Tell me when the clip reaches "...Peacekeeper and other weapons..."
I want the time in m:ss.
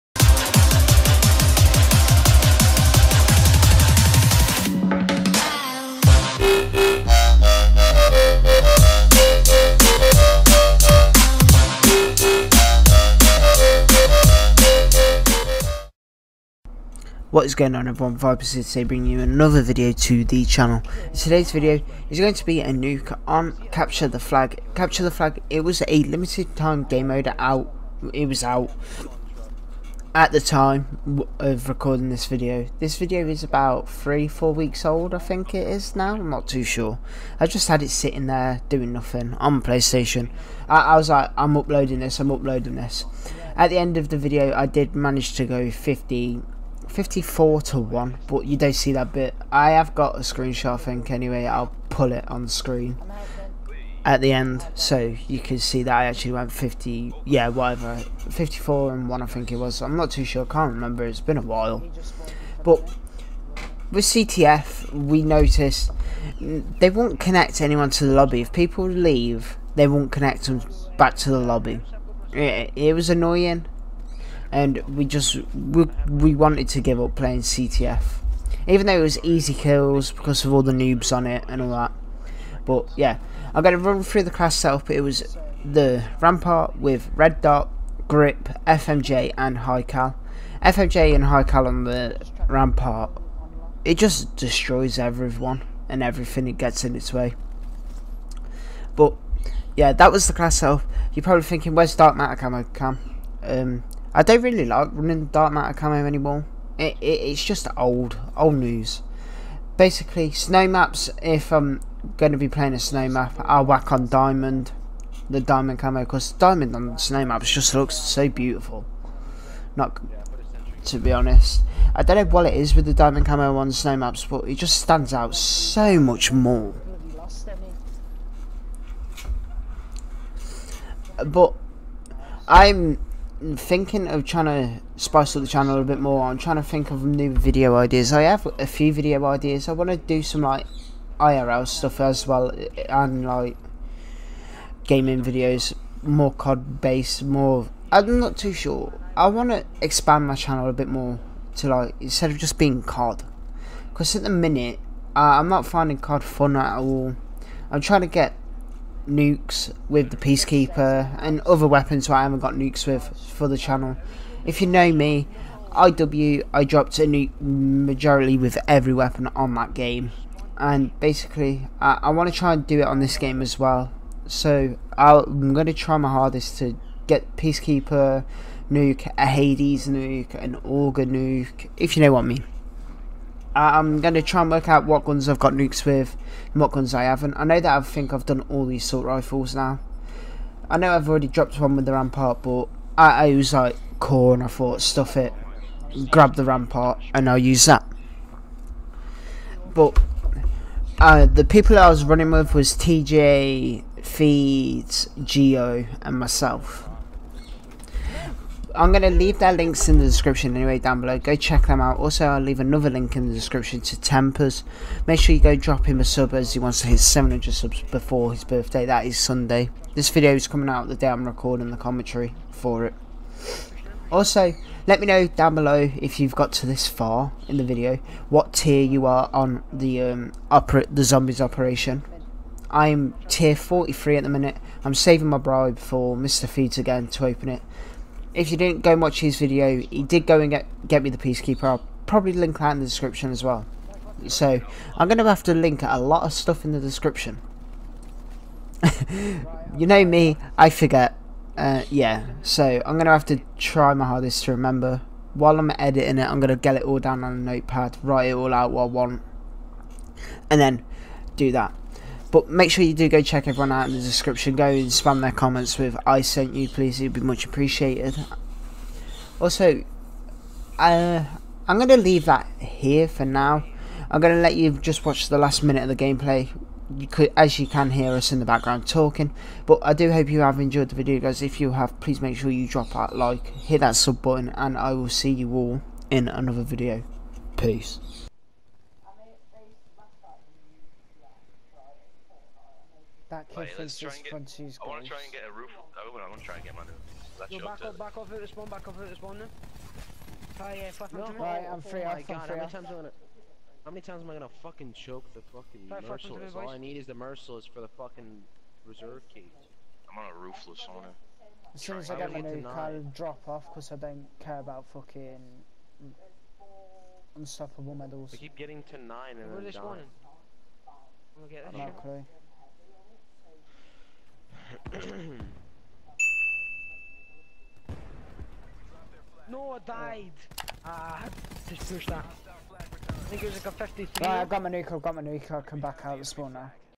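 2:40.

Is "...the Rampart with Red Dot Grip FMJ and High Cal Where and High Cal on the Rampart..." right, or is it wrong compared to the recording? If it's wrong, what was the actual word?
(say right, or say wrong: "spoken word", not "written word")
wrong: "FMJ", not "Where".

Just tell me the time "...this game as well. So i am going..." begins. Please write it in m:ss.
2:52.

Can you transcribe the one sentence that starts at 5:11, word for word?
As soon as I get my new car, i drop off because I don't care about fucking unstoppable medals.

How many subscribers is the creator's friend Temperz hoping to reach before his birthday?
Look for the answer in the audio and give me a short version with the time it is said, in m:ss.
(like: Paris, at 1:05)
700, at 3:36.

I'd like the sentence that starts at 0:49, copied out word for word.
I have got a screenshot, I think, anyway.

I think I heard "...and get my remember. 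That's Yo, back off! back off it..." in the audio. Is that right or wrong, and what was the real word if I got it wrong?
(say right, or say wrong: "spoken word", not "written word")
wrong: "under", not "remember".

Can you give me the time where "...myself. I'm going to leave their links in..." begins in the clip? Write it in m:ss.
3:26.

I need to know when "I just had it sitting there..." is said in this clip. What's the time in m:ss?
0:37.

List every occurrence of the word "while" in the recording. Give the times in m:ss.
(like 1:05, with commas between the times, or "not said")
1:01, 4:15.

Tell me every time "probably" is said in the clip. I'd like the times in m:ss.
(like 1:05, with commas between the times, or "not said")
1:41, 4:02.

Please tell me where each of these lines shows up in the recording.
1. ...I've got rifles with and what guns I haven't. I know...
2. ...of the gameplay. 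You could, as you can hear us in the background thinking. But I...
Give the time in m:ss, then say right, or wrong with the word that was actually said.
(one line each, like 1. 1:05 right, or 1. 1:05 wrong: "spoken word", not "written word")
1. 3:05 wrong: "nukes", not "rifles"
2. 4:35 wrong: "talking", not "thinking".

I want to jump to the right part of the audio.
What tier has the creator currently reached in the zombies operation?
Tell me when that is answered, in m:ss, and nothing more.
3:53.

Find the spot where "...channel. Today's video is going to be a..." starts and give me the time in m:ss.
0:20.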